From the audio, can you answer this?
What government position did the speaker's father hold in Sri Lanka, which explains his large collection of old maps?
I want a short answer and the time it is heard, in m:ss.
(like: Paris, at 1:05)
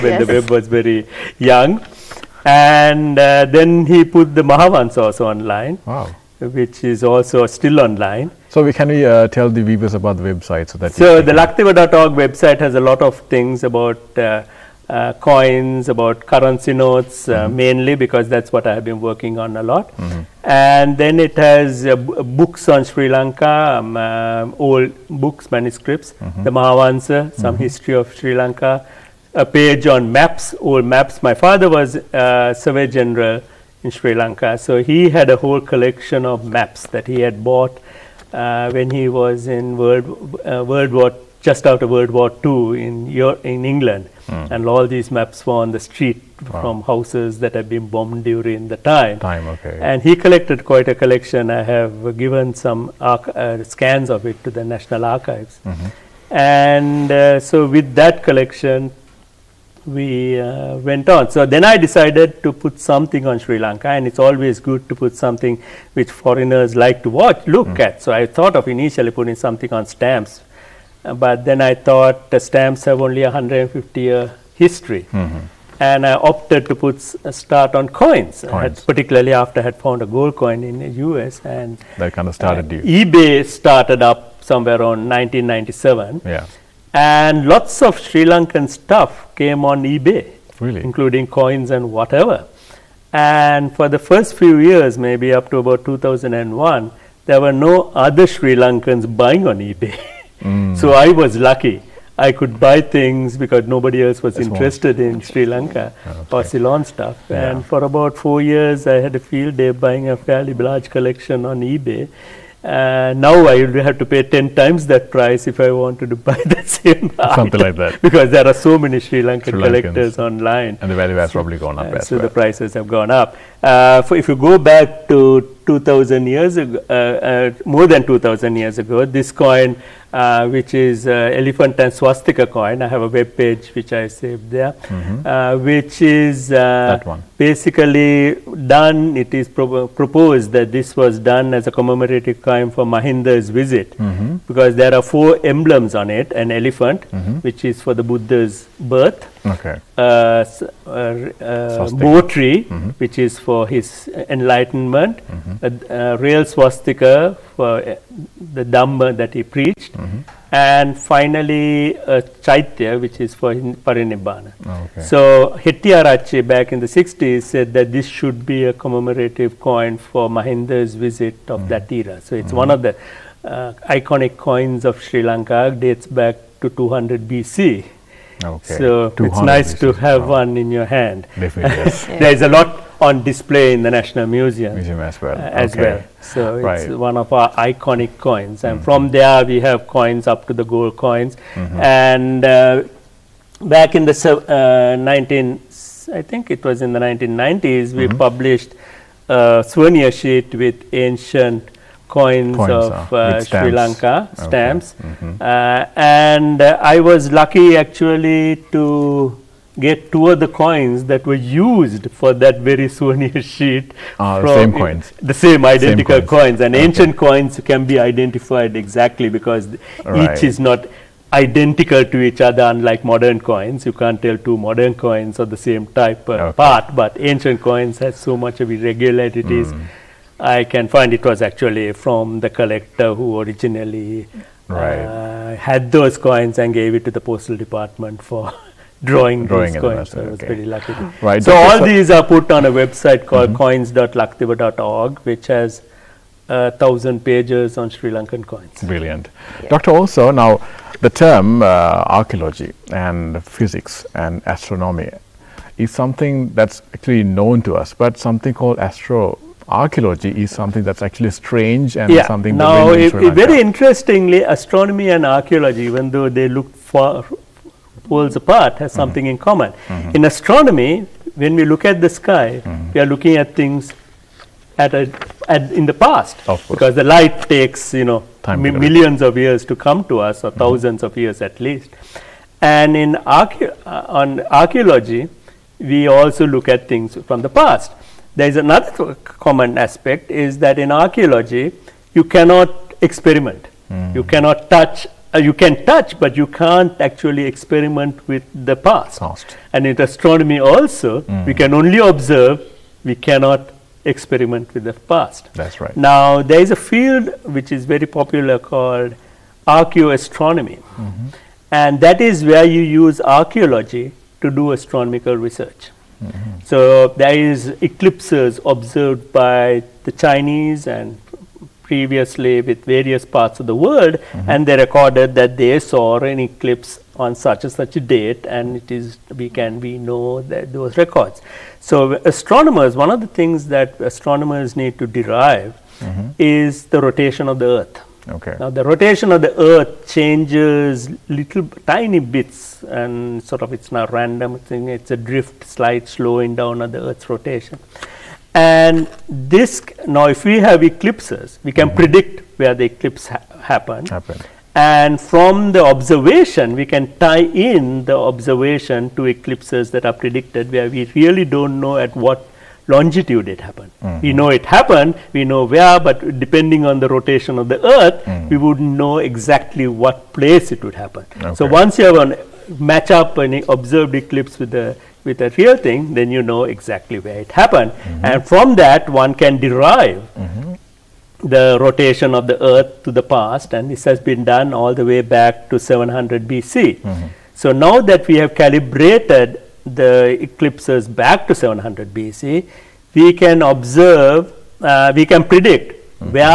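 Survey General, at 0:32.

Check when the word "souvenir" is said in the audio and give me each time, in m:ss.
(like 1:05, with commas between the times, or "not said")
3:19, 3:32.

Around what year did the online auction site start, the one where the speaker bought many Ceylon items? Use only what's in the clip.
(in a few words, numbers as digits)
1997.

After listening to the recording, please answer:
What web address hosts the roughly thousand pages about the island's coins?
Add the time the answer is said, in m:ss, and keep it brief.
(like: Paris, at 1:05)
coins.lakdiva.org, at 4:03.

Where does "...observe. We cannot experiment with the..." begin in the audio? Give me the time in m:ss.
5:01.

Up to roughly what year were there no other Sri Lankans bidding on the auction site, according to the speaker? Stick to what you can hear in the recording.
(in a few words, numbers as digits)
2001.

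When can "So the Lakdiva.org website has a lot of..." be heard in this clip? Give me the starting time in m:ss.
0:10.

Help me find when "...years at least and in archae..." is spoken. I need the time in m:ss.
4:41.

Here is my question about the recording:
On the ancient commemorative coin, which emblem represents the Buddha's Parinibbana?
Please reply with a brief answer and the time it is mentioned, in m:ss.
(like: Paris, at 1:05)
Chaitya, at 2:42.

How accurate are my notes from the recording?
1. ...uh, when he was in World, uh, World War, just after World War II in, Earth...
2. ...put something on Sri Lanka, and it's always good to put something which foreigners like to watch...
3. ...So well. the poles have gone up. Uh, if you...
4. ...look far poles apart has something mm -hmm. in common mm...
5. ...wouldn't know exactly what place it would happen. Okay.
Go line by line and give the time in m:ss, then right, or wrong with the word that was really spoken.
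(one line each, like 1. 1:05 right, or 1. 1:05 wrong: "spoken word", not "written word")
1. 0:38 wrong: "Euro", not "Earth"
2. 1:02 right
3. 2:02 wrong: "prices", not "poles"
4. 4:26 right
5. 6:08 right.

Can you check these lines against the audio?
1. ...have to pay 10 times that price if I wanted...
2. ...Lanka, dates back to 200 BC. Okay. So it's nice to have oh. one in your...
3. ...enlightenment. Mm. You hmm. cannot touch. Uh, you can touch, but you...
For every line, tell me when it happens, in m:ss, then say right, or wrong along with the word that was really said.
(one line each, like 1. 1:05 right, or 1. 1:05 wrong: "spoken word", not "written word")
1. 1:53 right
2. 2:55 right
3. 4:53 wrong: "experiment", not "enlightenment".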